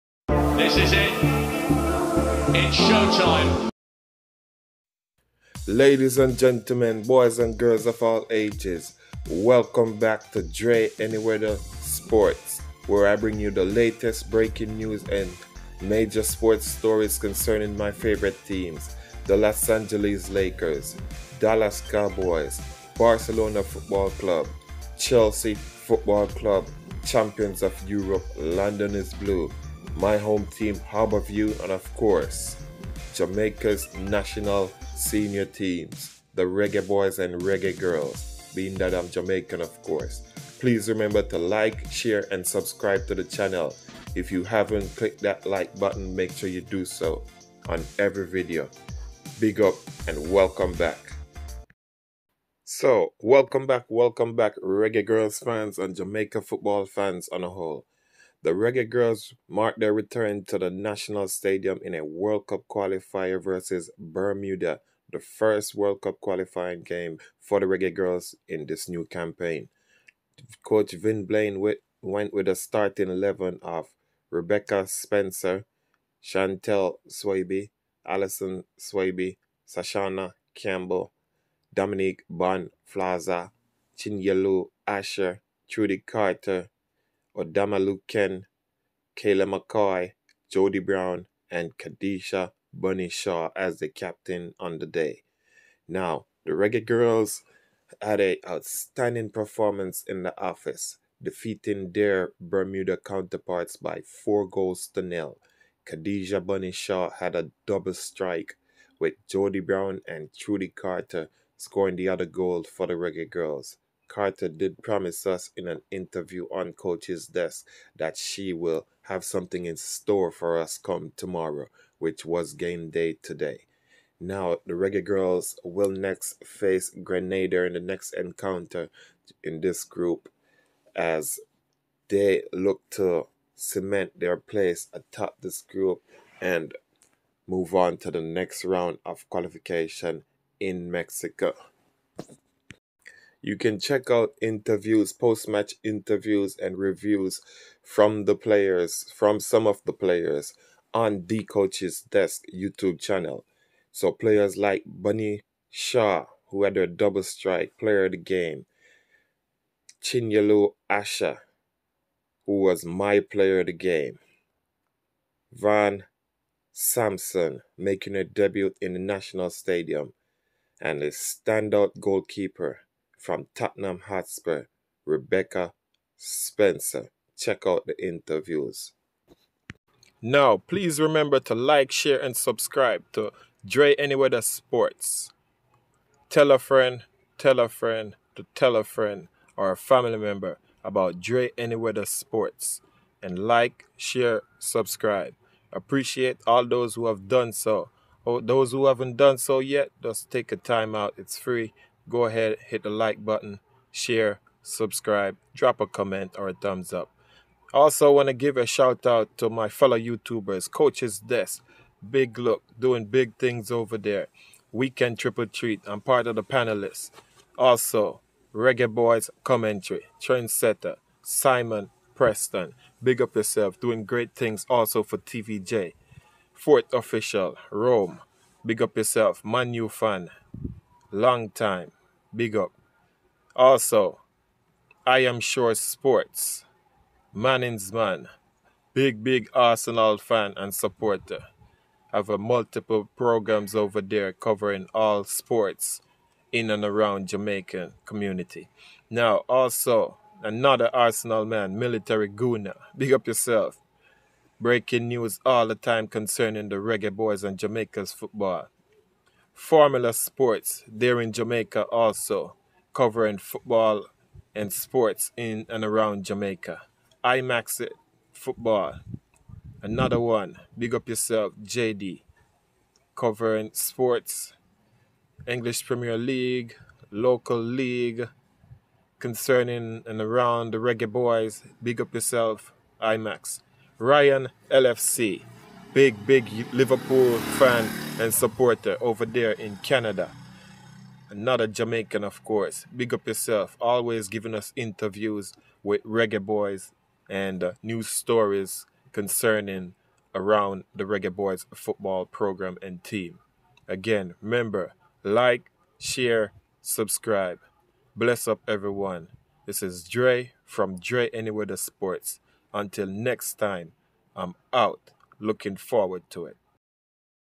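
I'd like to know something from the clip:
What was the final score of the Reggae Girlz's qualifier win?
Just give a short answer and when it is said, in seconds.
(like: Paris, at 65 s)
4-0, at 104 s.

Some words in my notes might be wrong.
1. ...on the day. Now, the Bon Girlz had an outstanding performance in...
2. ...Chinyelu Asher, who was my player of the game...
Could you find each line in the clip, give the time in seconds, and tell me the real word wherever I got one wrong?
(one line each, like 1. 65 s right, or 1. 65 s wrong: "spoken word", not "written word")
1. 94 s wrong: "Reggae", not "Bon"
2. 160 s right.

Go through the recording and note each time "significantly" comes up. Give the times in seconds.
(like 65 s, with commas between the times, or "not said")
not said.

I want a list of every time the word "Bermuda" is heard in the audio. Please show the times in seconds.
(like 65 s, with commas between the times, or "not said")
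63 s, 102 s.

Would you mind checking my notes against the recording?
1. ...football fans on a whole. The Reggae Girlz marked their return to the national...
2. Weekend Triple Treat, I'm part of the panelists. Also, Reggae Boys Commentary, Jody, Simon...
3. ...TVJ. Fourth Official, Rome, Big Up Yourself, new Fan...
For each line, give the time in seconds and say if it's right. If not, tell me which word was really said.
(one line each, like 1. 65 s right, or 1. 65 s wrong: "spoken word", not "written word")
1. 56 s right
2. 214 s wrong: "Trendsetter", not "Jody"
3. 225 s right.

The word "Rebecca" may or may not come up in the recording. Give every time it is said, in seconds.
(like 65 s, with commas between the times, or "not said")
74 s, 175 s.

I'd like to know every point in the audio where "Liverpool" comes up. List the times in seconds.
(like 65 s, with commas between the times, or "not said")
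286 s.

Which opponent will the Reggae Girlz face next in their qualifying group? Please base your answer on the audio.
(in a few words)
Grenada.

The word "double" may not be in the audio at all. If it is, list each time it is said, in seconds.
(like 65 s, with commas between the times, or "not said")
107 s, 156 s.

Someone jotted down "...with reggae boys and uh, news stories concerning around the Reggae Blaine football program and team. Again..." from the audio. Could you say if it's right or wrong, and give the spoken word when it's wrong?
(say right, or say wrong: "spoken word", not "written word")
wrong: "Boys", not "Blaine".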